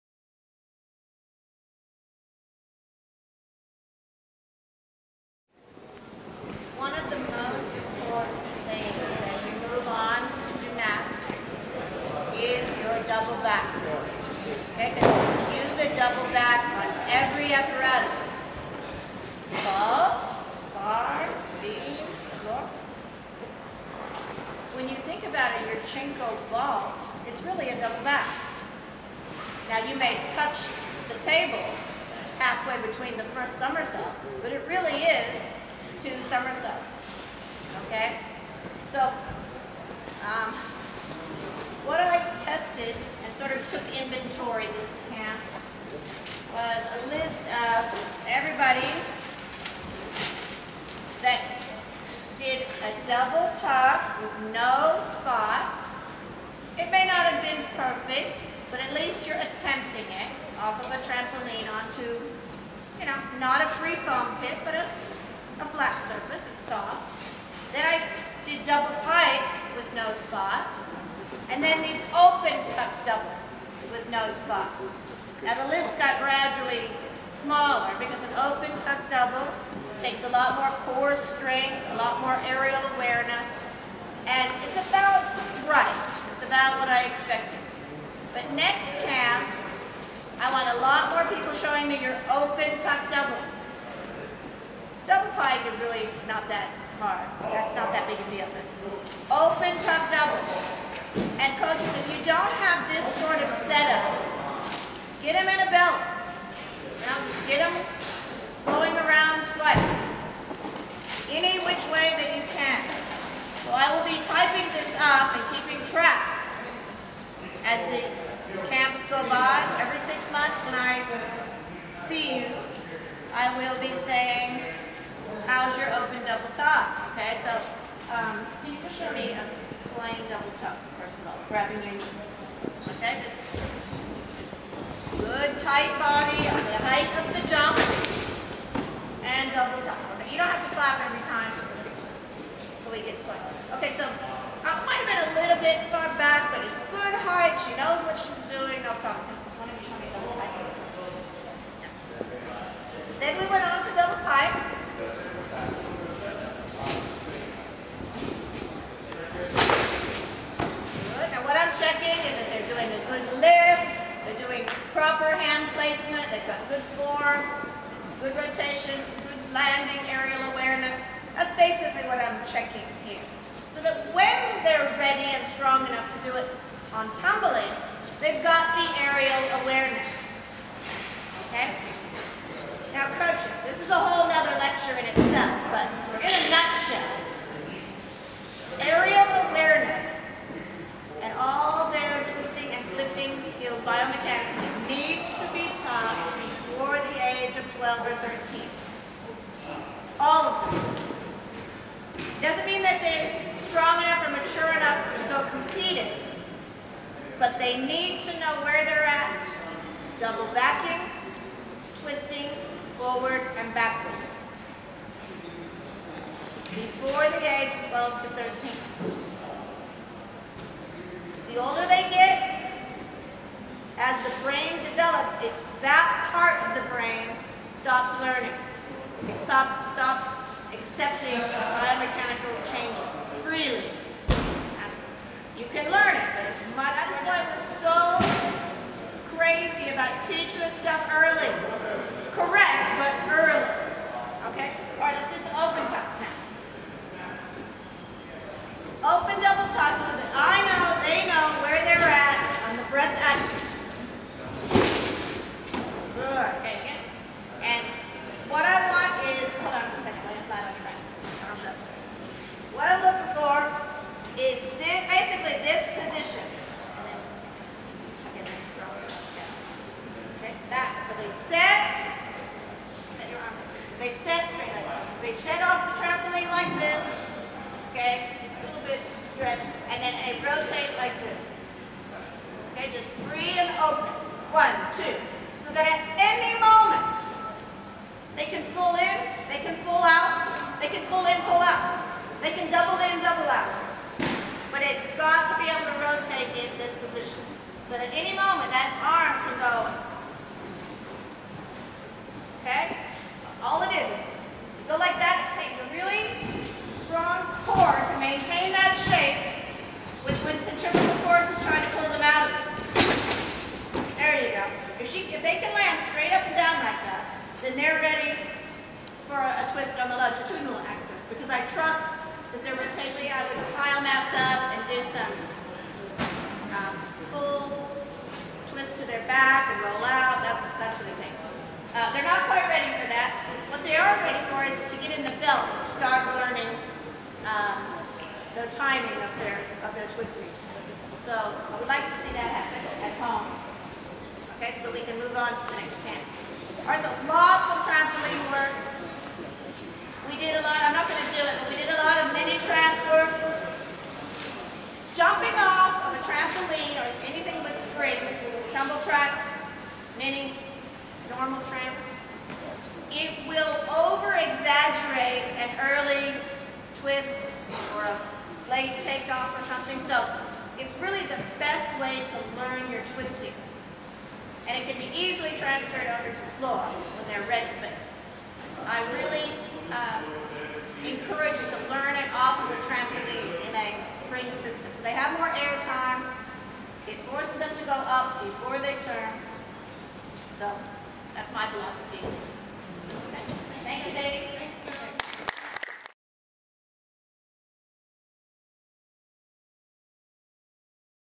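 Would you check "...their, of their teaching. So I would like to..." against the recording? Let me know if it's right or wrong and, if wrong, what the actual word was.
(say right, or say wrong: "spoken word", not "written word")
wrong: "twisting", not "teaching".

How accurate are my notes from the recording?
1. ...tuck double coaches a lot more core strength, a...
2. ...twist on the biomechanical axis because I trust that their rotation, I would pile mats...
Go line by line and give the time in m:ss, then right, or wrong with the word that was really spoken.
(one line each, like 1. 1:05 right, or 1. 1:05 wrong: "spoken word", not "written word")
1. 1:18 wrong: "takes", not "coaches"
2. 5:19 wrong: "longitudinal", not "biomechanical".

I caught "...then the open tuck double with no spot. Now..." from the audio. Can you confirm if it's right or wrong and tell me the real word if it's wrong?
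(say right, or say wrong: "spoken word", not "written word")
right.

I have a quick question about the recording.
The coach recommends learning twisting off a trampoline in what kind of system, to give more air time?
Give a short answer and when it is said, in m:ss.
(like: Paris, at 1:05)
Spring system, at 6:24.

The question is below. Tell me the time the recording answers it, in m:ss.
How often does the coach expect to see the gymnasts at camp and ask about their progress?
1:59.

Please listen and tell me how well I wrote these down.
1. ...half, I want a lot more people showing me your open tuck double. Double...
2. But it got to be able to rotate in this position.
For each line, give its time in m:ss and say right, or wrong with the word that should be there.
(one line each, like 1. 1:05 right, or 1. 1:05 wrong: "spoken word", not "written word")
1. 1:29 right
2. 4:54 right.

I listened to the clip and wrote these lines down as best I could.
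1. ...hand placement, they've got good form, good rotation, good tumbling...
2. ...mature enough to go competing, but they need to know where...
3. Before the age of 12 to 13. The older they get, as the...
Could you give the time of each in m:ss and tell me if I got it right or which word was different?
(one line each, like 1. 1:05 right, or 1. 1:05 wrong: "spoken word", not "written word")
1. 2:45 wrong: "landing", not "tumbling"
2. 3:24 right
3. 3:36 right.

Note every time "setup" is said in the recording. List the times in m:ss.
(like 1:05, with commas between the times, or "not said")
1:43.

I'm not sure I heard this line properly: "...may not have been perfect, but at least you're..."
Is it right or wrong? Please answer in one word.
right.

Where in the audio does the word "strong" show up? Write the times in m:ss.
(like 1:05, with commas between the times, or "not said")
2:55, 3:23.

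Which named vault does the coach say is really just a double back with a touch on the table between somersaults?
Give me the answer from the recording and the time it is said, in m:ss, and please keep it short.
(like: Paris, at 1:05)
Yurchenko, at 0:25.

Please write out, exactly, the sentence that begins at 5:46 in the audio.
All right, so lots of trampoline work.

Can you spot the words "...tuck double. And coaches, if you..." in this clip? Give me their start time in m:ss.
1:39.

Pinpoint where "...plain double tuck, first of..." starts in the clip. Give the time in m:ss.
2:09.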